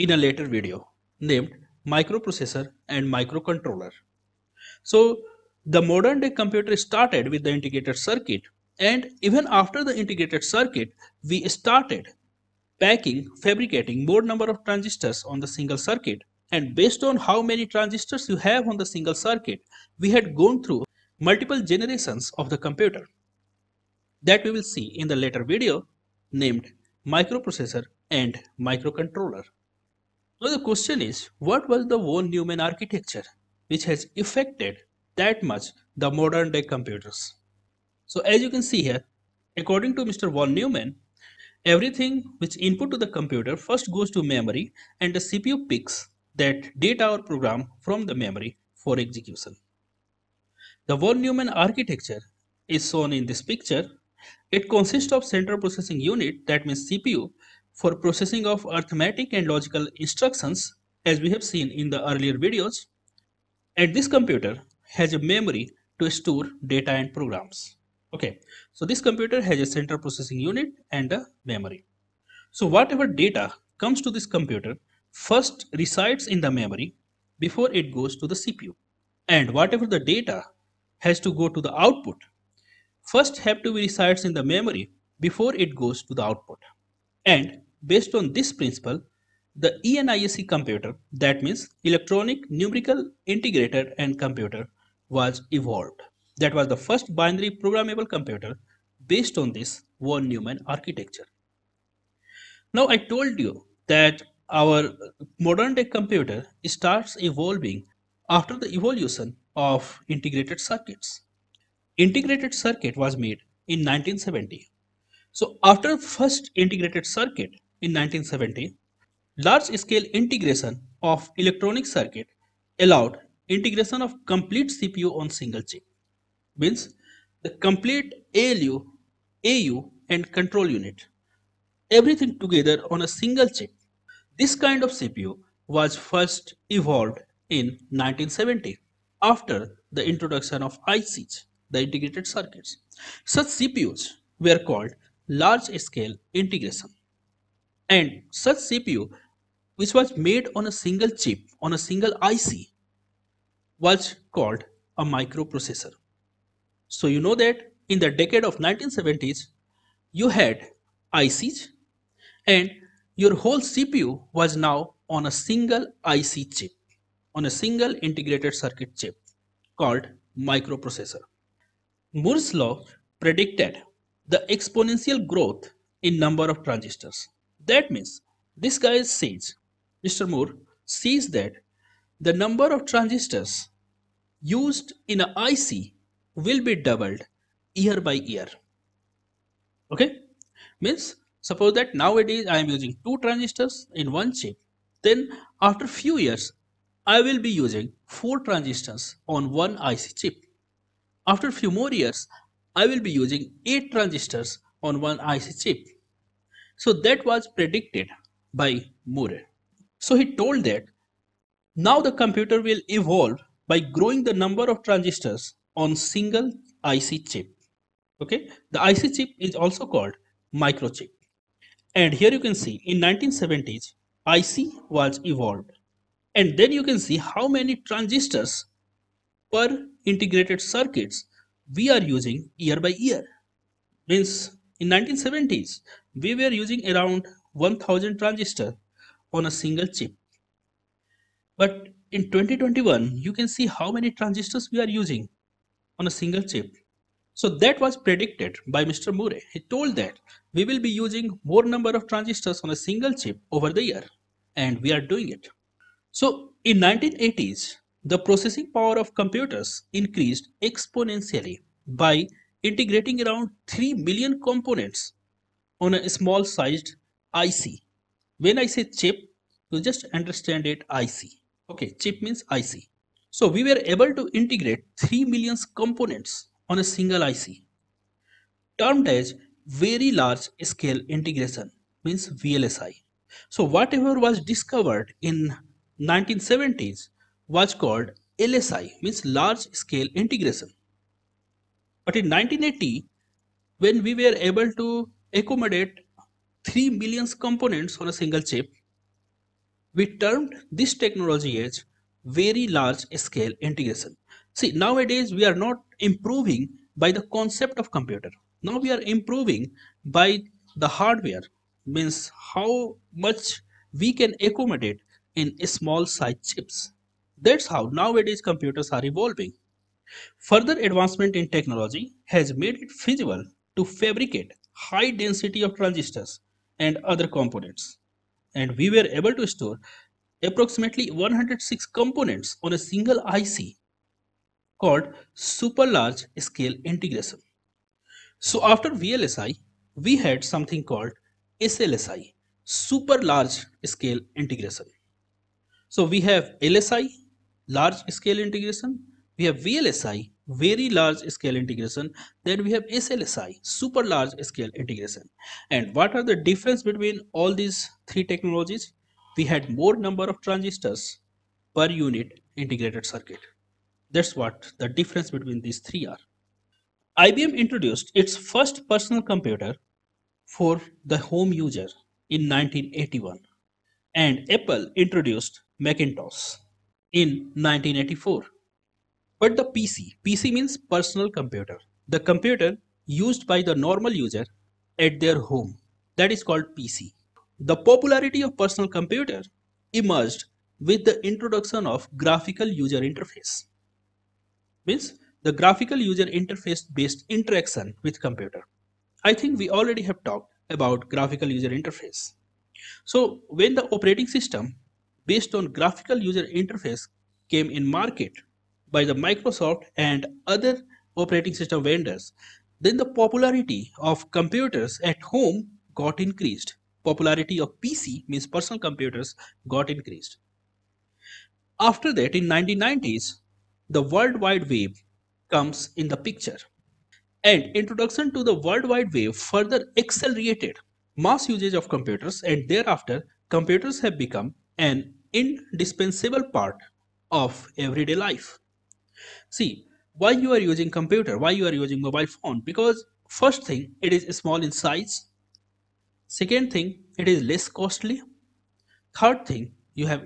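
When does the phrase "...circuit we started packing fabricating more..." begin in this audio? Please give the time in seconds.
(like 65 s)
10 s.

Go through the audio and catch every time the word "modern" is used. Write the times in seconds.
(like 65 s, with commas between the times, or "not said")
5 s, 36 s, 105 s.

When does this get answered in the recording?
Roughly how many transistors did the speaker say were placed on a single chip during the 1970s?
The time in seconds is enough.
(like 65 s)
237 s.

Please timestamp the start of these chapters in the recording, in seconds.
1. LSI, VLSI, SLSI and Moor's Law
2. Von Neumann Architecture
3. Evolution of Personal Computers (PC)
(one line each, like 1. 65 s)
1. 161 s
2. 29 s
3. 367 s.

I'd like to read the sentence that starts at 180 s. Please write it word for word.
Moore sees that the number of transistors used in an IC will be doubled year by year.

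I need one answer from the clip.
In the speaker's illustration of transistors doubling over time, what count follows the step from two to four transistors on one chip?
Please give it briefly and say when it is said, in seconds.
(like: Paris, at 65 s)
8, at 203 s.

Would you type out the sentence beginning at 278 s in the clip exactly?
Termed as very large scale integration means VLSI.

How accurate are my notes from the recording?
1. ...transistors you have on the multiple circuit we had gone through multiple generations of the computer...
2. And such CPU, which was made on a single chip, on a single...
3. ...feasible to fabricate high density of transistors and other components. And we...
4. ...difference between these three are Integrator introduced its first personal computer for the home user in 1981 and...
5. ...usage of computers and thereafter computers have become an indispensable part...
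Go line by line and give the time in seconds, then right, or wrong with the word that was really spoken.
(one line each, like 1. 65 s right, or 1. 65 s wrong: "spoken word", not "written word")
1. 17 s wrong: "single", not "multiple"
2. 147 s right
3. 322 s right
4. 364 s wrong: "IBM", not "Integrator"
5. 431 s right.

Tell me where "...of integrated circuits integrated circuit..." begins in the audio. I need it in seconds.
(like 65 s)
109 s.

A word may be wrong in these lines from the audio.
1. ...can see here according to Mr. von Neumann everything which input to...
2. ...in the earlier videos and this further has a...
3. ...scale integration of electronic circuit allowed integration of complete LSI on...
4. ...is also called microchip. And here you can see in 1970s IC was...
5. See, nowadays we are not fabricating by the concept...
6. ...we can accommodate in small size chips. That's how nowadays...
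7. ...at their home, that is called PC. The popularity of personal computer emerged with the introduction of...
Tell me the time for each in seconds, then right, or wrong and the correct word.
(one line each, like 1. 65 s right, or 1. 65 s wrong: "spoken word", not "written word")
1. 38 s right
2. 61 s wrong: "computer", not "further"
3. 119 s wrong: "CPU", not "LSI"
4. 219 s right
5. 304 s wrong: "improving", not "fabricating"
6. 313 s right
7. 384 s right.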